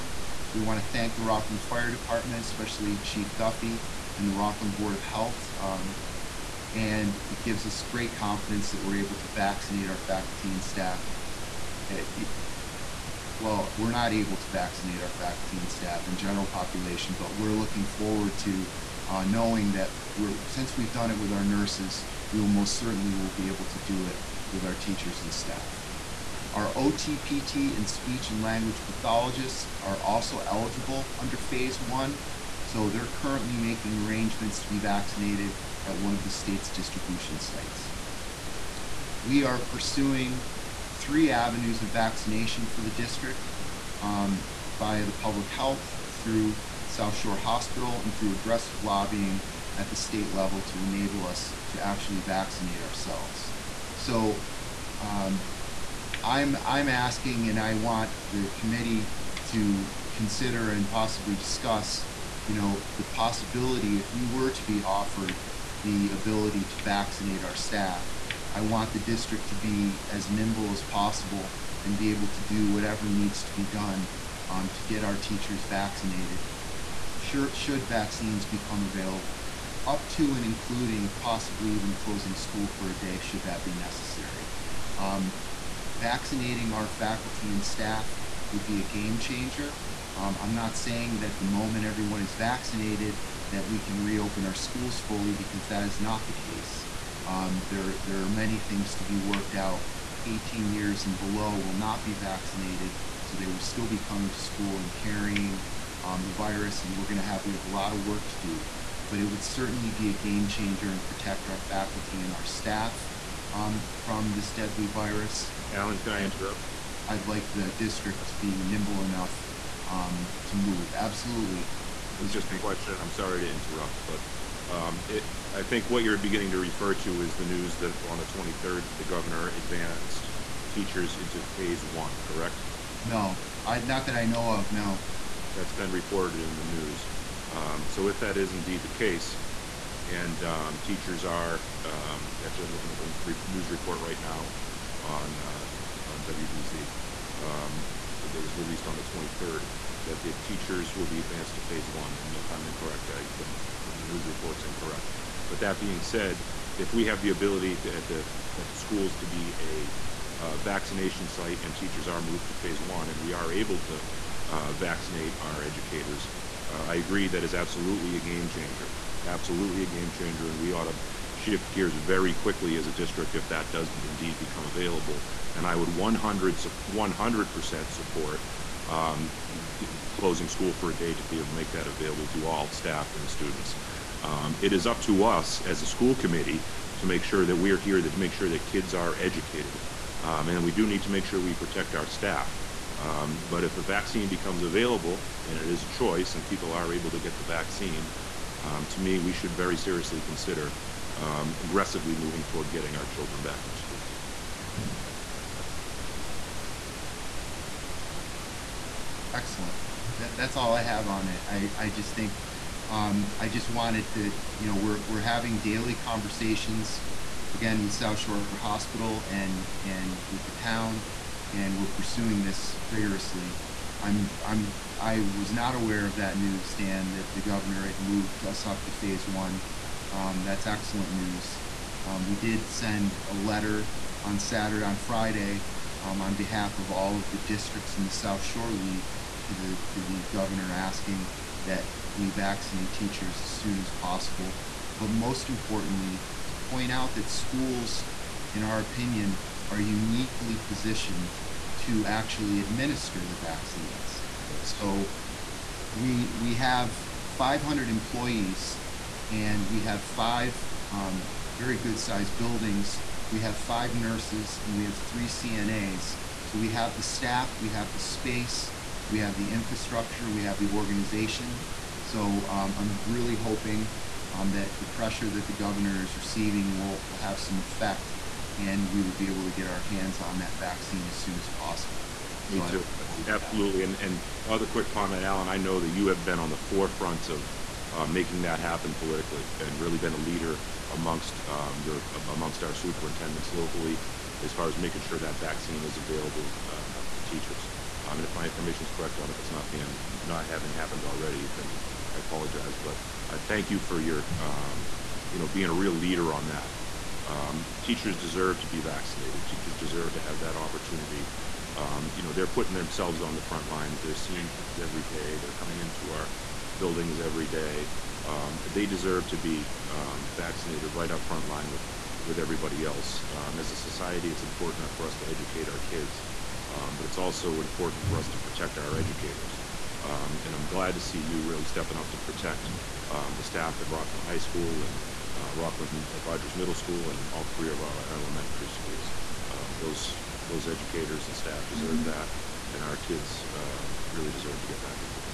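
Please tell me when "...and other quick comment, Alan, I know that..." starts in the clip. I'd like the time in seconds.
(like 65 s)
284 s.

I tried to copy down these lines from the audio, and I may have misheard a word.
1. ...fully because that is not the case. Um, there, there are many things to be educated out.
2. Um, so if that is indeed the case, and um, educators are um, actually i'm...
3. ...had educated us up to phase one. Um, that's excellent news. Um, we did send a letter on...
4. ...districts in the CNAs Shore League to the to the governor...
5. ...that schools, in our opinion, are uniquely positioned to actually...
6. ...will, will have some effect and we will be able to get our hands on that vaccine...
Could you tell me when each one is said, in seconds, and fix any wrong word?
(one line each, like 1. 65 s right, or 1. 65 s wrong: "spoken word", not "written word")
1. 94 s wrong: "worked", not "educated"
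2. 137 s wrong: "teachers", not "educators"
3. 227 s wrong: "moved", not "educated"
4. 237 s wrong: "South", not "CNAs"
5. 247 s right
6. 276 s right.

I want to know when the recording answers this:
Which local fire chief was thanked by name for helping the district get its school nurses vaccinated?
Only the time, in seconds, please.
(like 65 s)
2 s.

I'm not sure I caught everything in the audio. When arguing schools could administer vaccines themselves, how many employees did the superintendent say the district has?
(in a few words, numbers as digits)
500.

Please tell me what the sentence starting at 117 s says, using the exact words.
I'd like the district to be nimble enough um, to move.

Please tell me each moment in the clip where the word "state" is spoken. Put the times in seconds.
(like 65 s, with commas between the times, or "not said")
36 s, 49 s.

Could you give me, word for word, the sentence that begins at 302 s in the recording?
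But I uh, thank you for your um, you know being a real leader on that um, teachers deserve to be vaccinated.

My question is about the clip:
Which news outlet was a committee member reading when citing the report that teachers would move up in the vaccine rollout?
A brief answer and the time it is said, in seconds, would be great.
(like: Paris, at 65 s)
WBZ, at 146 s.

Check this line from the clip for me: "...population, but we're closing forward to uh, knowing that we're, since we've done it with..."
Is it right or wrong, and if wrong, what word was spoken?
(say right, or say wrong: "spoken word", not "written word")
wrong: "looking", not "closing".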